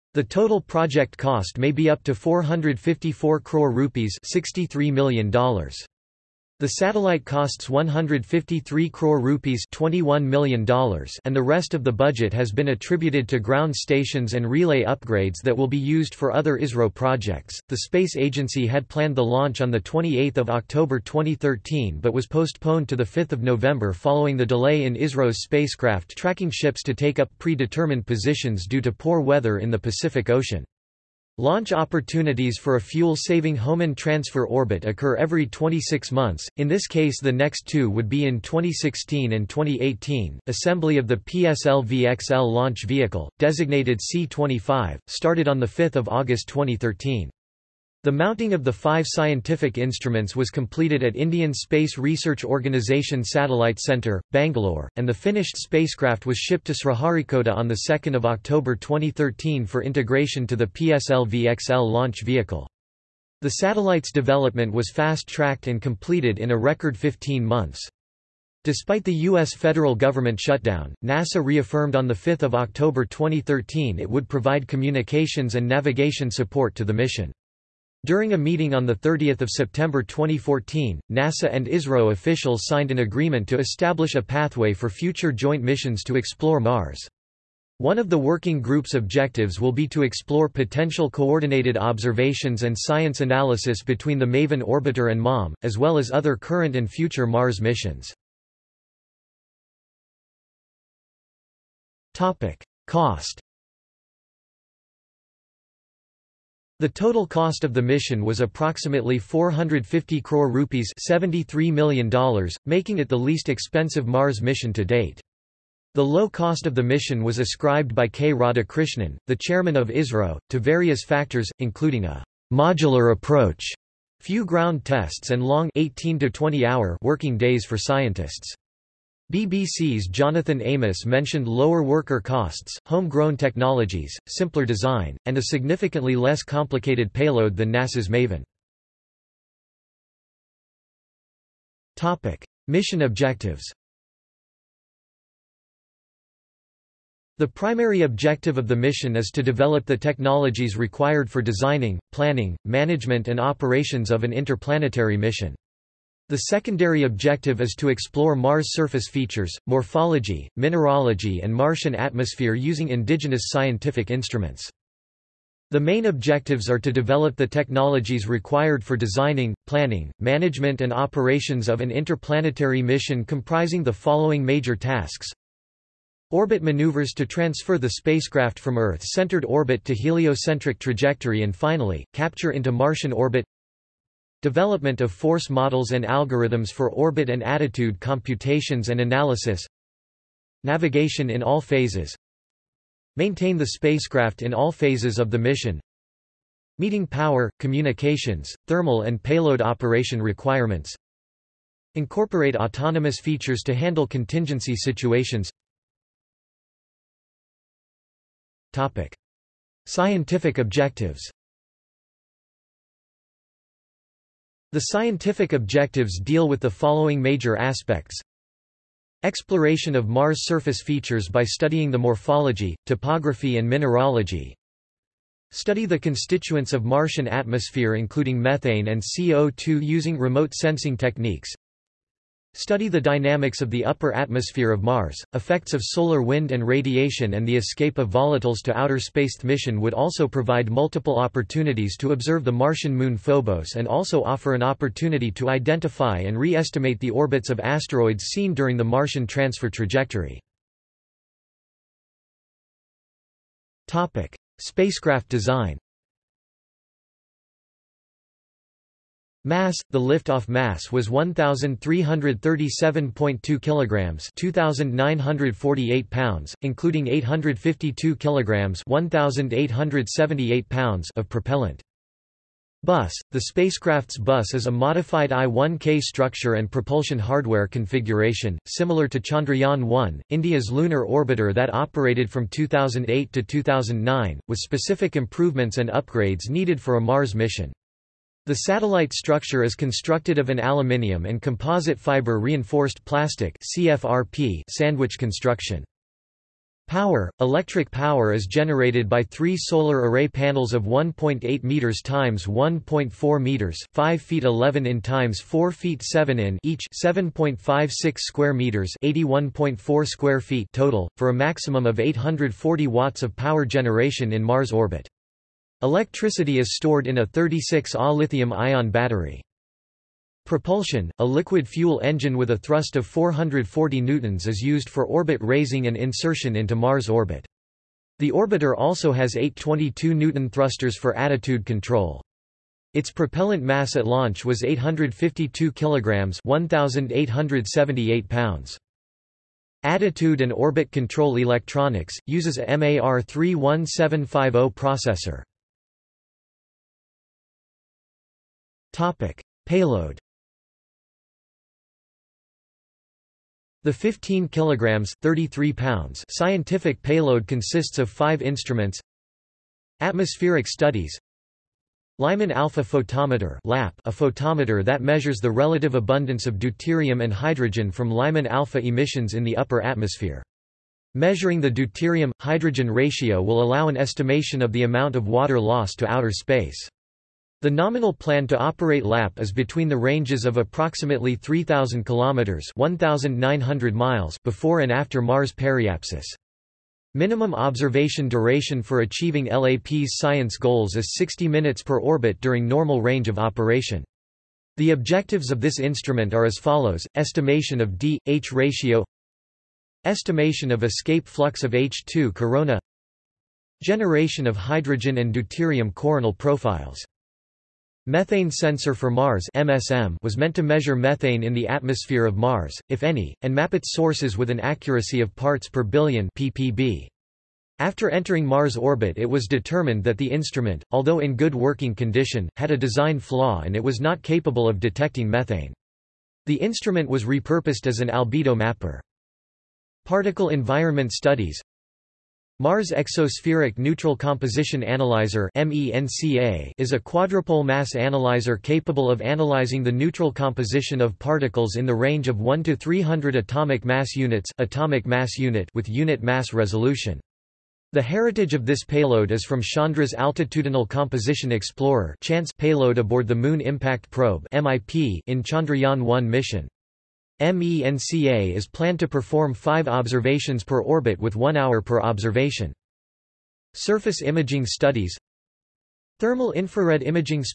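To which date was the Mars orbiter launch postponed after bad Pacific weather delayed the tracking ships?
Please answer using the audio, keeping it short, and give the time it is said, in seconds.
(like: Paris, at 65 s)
5th of November, at 23 s.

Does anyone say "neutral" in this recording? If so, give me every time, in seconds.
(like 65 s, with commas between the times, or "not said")
433 s, 439 s.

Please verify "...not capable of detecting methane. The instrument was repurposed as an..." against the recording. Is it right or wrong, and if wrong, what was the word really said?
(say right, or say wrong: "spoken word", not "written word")
right.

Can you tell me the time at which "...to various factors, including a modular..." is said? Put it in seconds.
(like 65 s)
120 s.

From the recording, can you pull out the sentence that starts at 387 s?
Minimum observation duration for achieving LAP's science goals is 60 minutes per orbit during normal range of operation.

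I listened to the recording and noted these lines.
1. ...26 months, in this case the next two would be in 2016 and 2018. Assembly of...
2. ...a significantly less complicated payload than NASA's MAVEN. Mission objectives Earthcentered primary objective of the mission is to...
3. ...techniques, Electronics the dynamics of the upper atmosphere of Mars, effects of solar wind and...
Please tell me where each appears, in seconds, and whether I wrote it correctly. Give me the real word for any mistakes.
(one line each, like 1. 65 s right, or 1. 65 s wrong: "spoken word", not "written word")
1. 35 s right
2. 135 s wrong: "The", not "Earthcentered"
3. 230 s wrong: "Study", not "Electronics".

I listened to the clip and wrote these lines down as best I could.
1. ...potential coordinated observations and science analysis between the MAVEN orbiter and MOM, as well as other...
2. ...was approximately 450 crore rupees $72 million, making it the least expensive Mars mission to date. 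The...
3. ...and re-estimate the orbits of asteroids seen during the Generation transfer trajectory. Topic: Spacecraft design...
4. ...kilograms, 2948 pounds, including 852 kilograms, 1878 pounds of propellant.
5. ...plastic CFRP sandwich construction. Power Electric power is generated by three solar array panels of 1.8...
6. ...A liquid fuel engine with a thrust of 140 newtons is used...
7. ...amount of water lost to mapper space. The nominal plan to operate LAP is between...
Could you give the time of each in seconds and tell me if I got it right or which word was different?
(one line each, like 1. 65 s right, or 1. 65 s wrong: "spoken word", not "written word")
1. 90 s right
2. 108 s wrong: "73", not "72"
3. 246 s wrong: "Martian", not "Generation"
4. 263 s right
5. 293 s right
6. 321 s wrong: "440", not "140"
7. 374 s wrong: "outer", not "mapper".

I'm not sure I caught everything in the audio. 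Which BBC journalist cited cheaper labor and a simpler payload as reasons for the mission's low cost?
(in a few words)
Jonathan Amos.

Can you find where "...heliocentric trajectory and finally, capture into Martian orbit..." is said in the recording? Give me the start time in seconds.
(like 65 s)
179 s.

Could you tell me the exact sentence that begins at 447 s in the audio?
The heritage of this payload is from Chandra's Altitudinal Composition Explorer payload aboard the Moon Impact Probe in Chandrayaan-1 mission.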